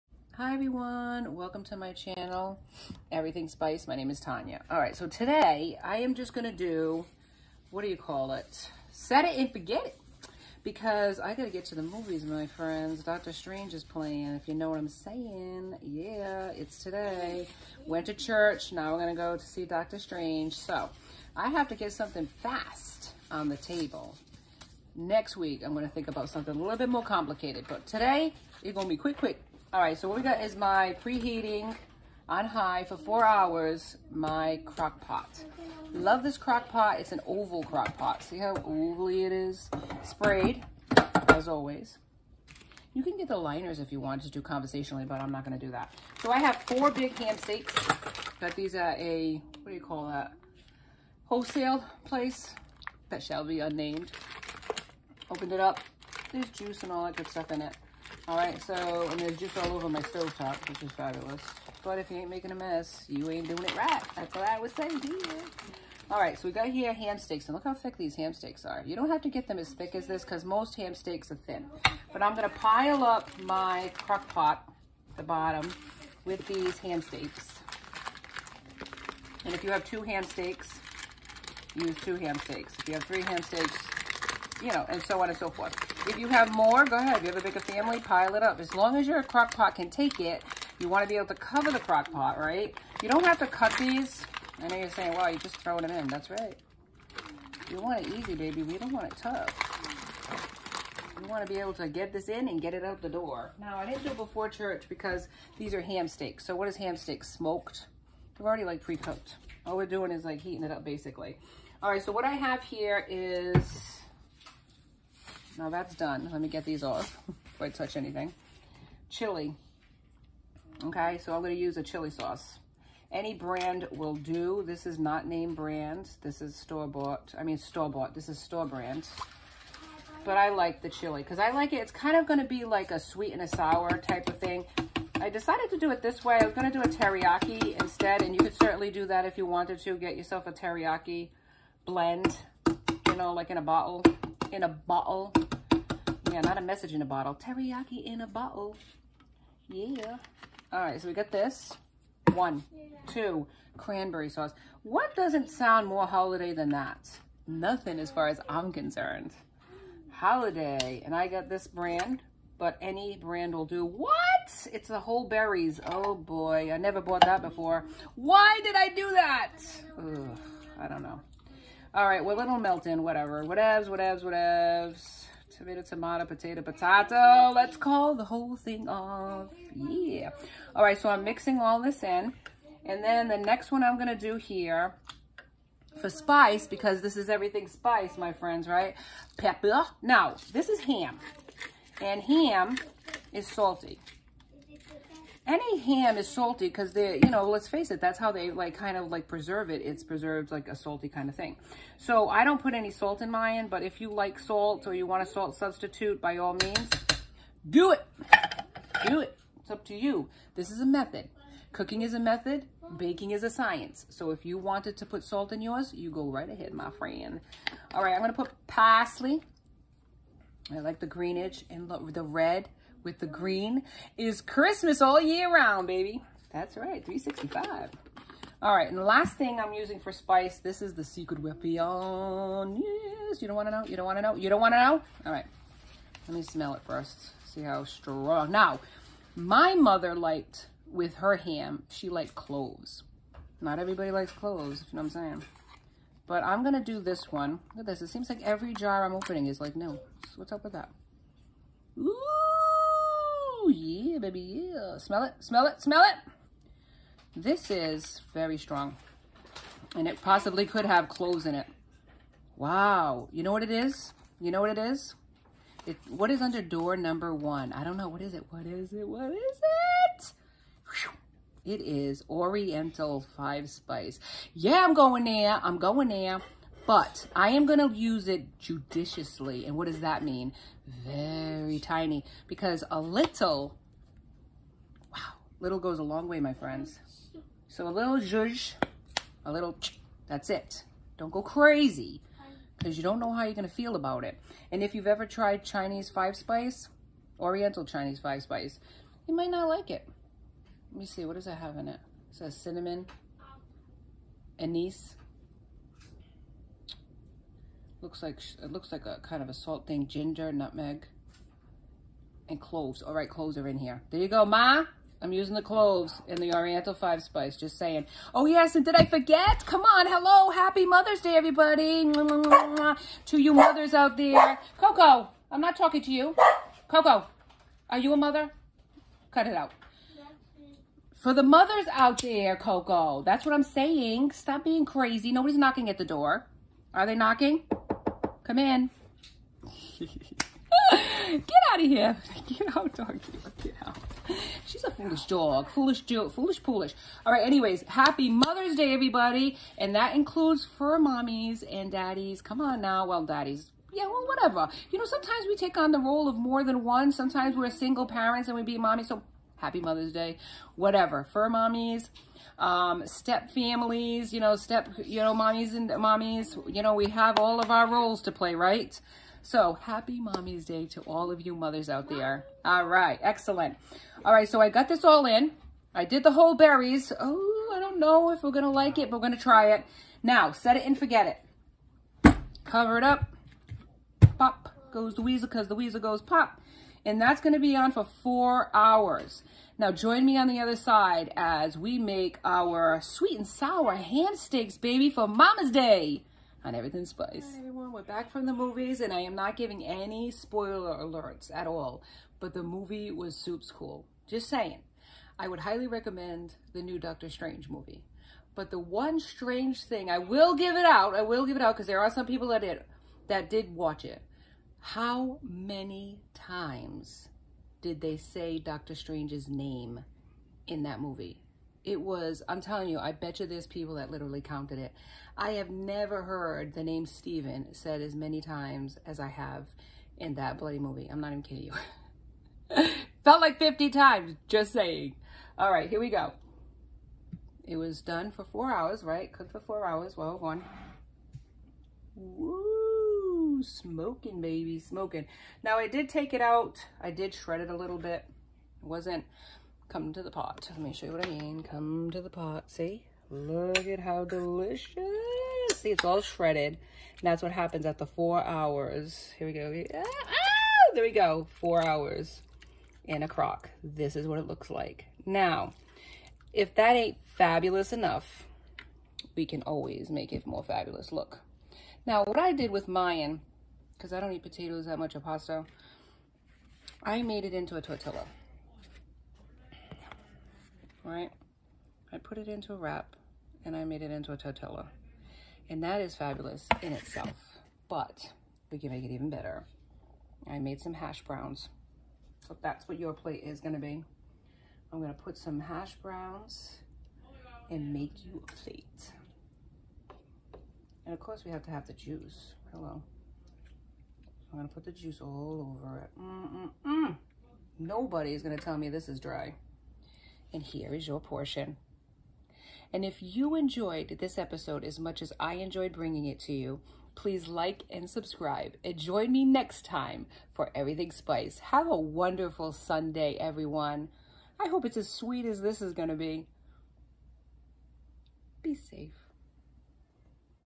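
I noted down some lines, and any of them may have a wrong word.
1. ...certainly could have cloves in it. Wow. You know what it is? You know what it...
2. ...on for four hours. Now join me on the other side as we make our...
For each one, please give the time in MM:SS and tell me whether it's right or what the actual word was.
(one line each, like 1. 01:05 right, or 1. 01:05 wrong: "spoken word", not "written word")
1. 04:20 wrong: "possibly", not "certainly"
2. 06:27 right.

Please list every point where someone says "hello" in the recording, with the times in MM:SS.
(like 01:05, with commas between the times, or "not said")
05:20, 08:22.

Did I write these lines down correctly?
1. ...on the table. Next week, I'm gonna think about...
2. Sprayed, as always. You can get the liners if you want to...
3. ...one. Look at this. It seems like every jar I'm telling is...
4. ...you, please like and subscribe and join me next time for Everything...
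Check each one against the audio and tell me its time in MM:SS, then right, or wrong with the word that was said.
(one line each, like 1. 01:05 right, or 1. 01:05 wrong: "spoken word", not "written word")
1. 00:23 right
2. 00:40 right
3. 04:07 wrong: "opening", not "telling"
4. 08:36 right.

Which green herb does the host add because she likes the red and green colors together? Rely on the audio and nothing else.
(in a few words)
Parsley.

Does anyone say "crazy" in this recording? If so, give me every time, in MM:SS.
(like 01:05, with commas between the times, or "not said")
04:51, 05:34.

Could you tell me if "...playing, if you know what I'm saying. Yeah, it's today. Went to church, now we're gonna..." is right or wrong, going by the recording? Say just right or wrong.
right.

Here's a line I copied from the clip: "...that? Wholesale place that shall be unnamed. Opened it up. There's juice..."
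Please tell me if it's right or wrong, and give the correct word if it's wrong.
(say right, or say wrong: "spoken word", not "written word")
right.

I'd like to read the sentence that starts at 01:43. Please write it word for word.
Now, I didn't do it before church because these are ham steaks.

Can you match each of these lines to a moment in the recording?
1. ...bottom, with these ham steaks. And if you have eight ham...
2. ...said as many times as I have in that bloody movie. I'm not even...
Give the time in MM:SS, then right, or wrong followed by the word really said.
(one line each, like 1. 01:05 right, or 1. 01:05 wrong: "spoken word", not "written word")
1. 01:15 wrong: "two", not "eight"
2. 07:07 right.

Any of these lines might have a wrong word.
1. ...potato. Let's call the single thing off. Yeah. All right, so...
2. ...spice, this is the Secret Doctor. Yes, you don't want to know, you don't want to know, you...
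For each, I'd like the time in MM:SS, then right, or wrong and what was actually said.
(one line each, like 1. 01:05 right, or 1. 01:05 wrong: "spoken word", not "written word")
1. 02:56 wrong: "whole", not "single"
2. 03:50 wrong: "Weapon", not "Doctor".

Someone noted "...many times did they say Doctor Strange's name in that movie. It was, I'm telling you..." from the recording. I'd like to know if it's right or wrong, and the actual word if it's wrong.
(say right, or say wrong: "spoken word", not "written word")
right.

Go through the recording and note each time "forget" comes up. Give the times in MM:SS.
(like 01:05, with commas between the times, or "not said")
00:09, 05:19, 06:20.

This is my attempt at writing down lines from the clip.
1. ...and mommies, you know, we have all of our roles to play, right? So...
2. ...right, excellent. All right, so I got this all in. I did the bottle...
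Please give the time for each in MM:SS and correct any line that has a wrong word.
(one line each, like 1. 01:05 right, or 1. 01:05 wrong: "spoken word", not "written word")
1. 06:05 right
2. 06:12 wrong: "whole", not "bottle".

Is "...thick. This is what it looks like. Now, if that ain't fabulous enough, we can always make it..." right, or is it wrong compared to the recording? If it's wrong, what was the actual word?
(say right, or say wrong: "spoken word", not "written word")
wrong: "crock", not "thick".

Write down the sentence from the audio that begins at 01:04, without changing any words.
That's what I would say here.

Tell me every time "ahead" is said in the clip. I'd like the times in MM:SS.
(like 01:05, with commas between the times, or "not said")
01:26, 03:36.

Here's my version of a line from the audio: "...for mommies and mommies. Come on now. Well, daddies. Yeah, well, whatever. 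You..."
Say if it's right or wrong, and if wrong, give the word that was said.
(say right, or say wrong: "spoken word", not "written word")
wrong: "daddies", not "mommies".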